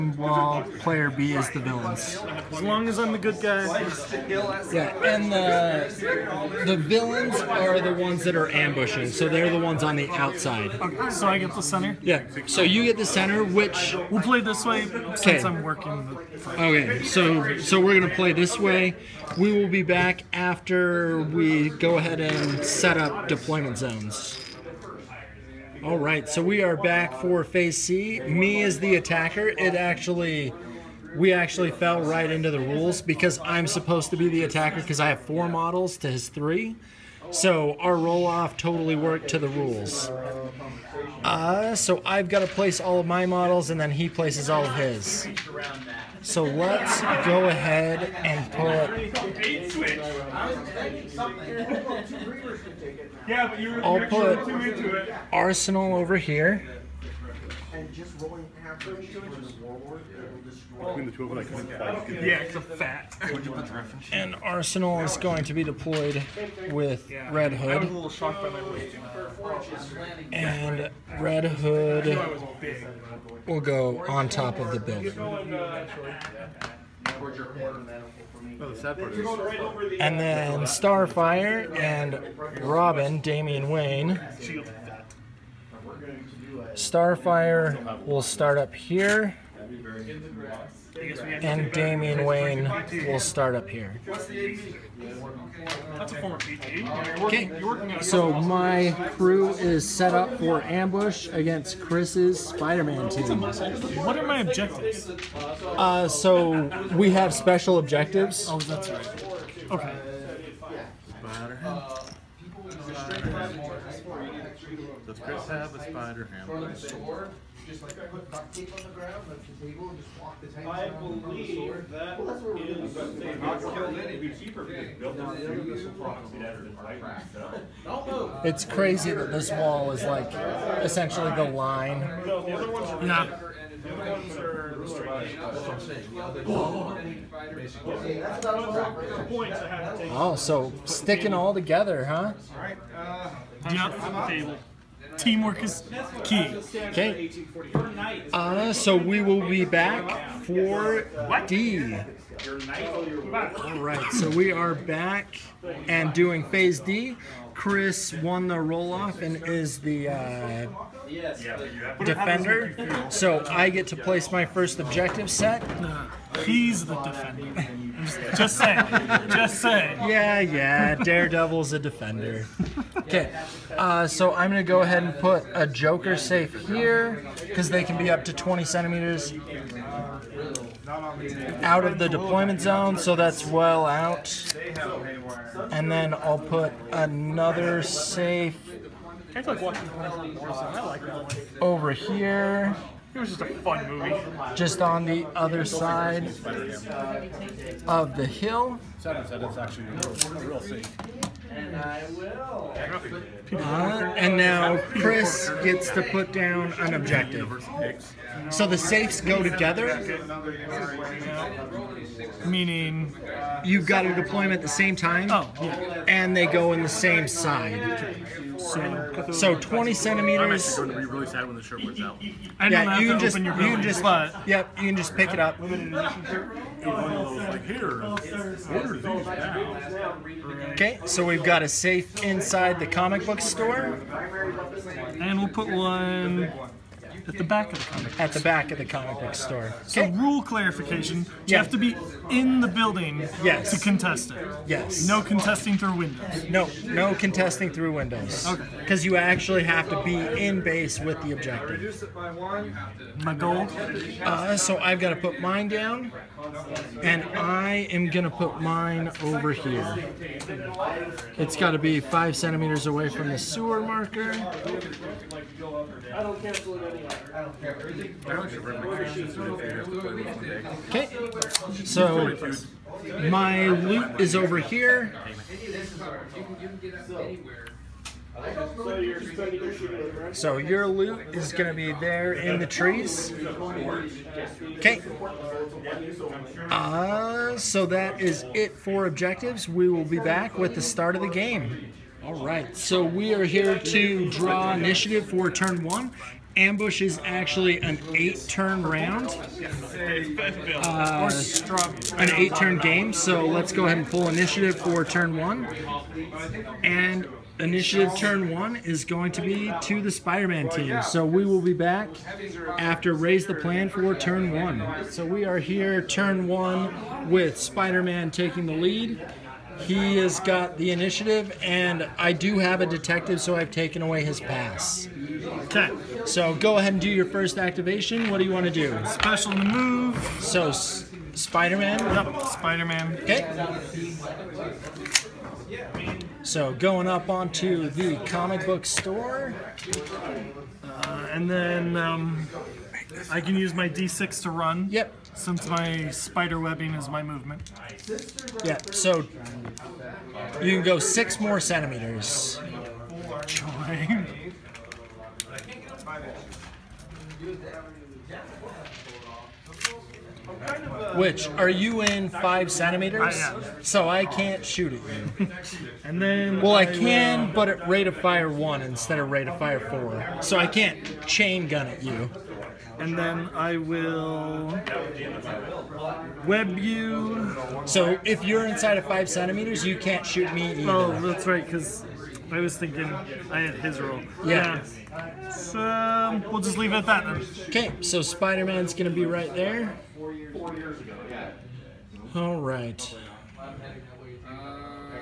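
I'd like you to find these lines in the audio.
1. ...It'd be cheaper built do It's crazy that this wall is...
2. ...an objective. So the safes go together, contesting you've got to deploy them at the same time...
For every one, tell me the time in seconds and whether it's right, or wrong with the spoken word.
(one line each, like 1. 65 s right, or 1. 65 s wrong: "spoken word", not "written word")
1. 124 s right
2. 206 s wrong: "meaning", not "contesting".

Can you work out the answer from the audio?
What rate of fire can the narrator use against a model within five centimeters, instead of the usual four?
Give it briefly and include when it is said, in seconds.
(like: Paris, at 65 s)
1, at 367 s.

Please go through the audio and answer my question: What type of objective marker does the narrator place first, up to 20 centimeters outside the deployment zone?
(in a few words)
Joker safe.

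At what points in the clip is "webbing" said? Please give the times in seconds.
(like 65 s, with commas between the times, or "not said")
346 s.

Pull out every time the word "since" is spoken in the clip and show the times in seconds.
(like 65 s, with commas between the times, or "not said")
15 s, 345 s.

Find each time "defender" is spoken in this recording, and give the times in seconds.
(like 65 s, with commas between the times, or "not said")
162 s, 167 s, 171 s.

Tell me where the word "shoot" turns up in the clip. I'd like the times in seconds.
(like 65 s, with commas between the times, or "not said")
364 s, 380 s.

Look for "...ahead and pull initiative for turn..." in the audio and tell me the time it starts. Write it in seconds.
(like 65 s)
303 s.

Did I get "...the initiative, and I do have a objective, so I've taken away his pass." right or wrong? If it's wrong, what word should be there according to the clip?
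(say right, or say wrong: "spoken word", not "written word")
wrong: "detective", not "objective".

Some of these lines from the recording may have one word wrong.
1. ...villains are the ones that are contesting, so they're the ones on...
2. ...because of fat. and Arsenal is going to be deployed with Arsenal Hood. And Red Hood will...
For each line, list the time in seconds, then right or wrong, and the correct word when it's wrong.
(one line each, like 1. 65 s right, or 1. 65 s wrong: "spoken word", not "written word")
1. 6 s wrong: "ambushing", not "contesting"
2. 62 s wrong: "Red", not "Arsenal".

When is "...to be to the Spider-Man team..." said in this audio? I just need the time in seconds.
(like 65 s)
309 s.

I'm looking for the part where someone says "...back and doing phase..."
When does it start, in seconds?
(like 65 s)
154 s.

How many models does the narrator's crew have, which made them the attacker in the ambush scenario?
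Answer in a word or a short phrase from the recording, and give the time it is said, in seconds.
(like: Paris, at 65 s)
4 models, at 35 s.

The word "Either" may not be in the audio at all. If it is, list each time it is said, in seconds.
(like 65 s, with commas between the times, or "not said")
380 s.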